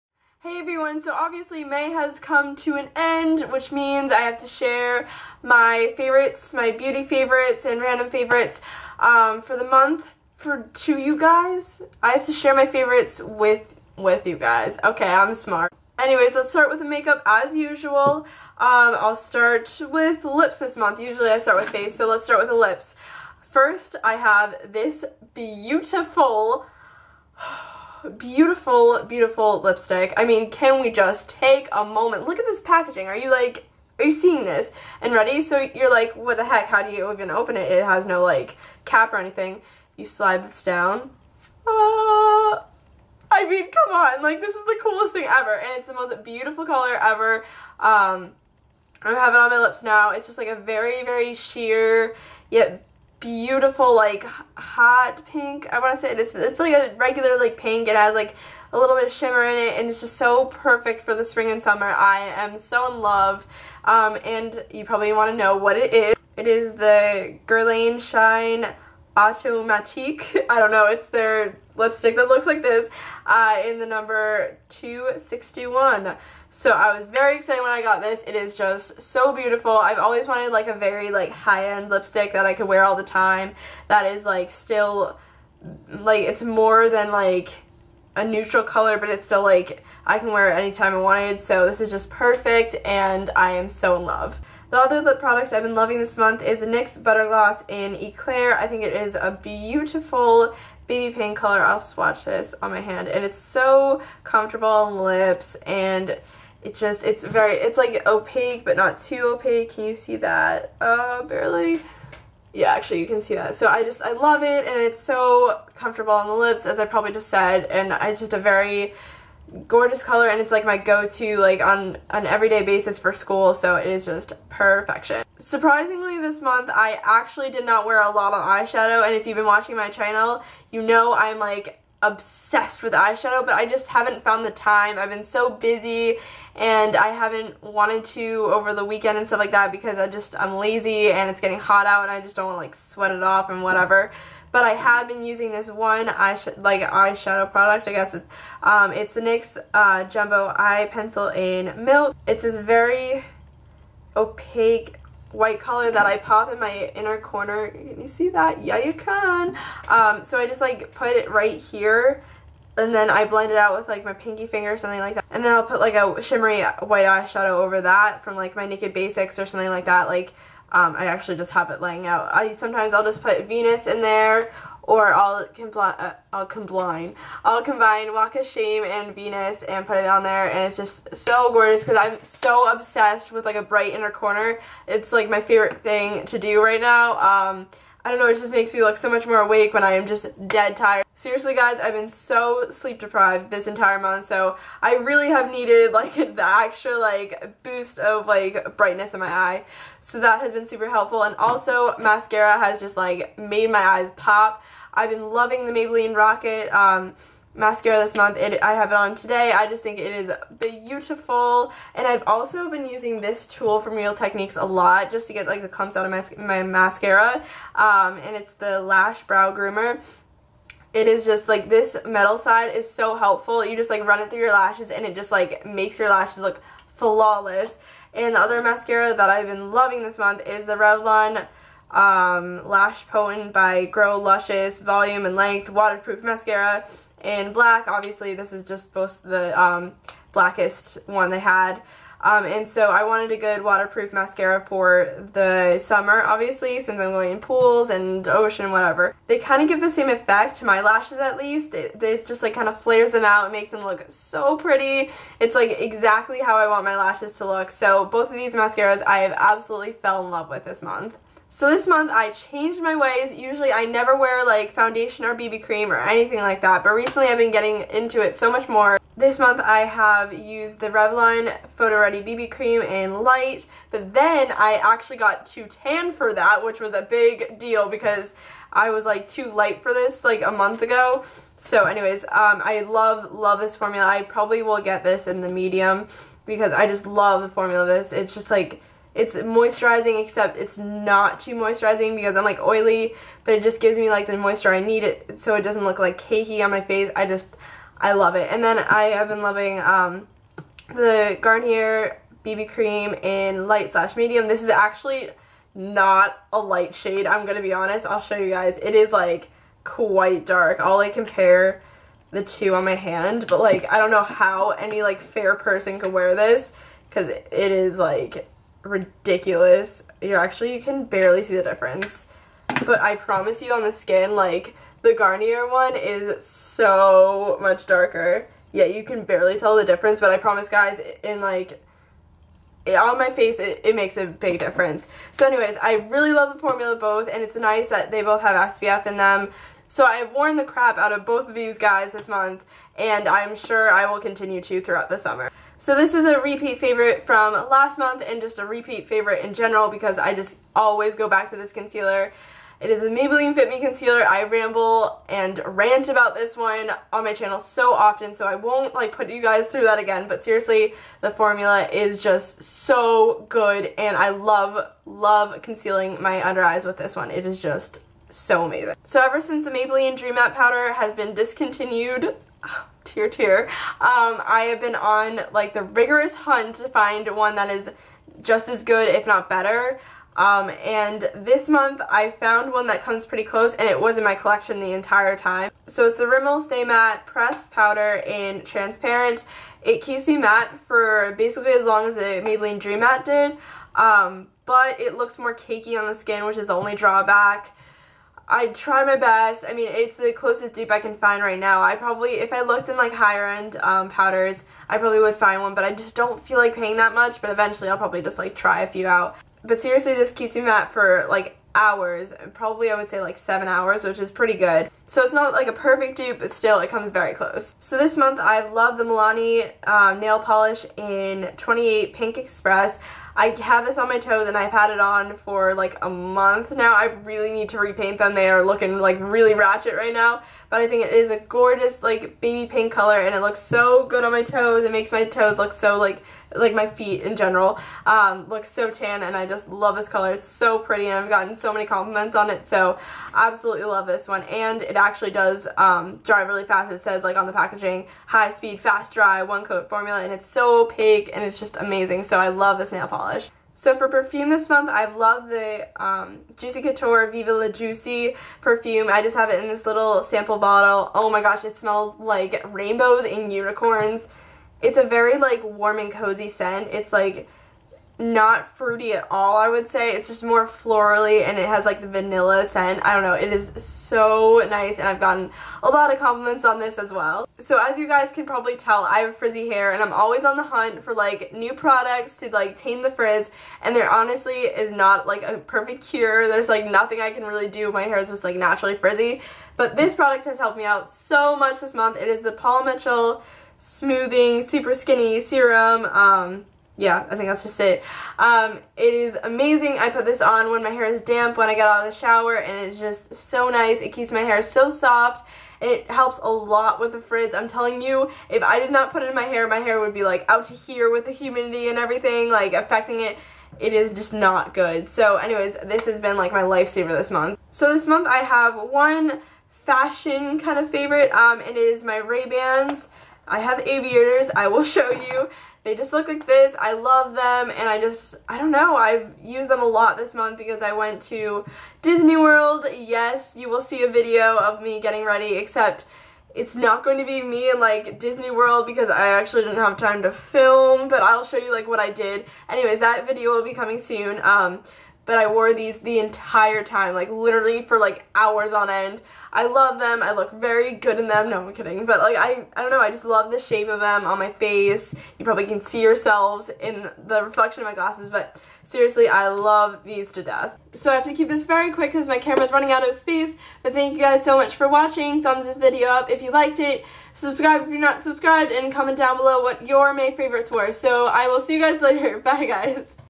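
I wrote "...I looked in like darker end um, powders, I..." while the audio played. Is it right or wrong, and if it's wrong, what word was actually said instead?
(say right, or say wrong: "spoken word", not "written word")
wrong: "higher", not "darker".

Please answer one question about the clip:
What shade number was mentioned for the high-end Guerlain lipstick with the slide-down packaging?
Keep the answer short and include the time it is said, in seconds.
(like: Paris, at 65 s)
261, at 74 s.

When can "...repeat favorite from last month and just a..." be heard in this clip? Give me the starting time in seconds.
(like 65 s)
346 s.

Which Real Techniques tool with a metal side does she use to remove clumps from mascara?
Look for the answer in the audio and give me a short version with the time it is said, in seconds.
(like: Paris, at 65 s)
Lash Brow Groomer, at 218 s.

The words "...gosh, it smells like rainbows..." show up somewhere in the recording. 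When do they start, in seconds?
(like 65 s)
461 s.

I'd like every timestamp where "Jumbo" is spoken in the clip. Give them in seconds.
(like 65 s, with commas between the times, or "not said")
150 s.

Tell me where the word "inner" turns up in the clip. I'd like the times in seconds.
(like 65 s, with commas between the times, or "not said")
156 s, 183 s.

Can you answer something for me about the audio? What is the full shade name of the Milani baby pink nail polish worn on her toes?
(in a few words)
28 Pink Express.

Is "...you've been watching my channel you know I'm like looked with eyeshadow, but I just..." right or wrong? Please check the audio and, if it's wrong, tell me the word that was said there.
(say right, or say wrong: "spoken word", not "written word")
wrong: "obsessed", not "looked".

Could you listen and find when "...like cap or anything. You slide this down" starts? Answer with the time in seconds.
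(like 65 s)
38 s.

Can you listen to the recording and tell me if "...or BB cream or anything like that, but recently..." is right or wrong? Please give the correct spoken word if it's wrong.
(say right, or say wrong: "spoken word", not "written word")
right.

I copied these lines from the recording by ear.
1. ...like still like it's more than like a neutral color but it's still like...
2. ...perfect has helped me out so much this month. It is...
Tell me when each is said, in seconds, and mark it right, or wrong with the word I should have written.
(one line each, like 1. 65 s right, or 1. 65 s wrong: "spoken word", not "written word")
1. 84 s right
2. 490 s wrong: "product", not "perfect".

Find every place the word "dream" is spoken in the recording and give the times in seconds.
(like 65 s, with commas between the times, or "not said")
370 s, 392 s.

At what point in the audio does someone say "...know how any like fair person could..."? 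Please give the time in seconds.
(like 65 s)
314 s.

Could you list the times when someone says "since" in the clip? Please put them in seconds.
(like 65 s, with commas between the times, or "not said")
246 s, 369 s.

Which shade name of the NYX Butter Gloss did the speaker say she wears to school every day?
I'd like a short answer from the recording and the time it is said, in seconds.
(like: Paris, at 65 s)
Eclair, at 97 s.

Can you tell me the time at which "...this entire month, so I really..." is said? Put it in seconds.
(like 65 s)
193 s.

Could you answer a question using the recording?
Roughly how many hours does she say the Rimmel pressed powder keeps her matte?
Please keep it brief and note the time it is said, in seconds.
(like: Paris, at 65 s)
7, at 413 s.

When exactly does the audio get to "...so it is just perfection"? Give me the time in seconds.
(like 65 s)
123 s.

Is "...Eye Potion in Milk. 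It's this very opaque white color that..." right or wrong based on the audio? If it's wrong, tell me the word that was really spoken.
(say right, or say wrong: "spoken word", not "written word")
wrong: "Pencil", not "Potion".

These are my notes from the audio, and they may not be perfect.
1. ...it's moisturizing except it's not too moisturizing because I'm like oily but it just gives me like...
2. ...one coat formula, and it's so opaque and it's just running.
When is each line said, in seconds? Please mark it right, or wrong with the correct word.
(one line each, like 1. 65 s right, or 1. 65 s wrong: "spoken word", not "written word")
1. 289 s right
2. 449 s wrong: "amazing", not "running".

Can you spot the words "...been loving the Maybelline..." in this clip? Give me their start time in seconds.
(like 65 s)
205 s.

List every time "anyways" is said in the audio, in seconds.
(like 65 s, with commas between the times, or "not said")
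15 s, 281 s, 335 s, 515 s, 542 s.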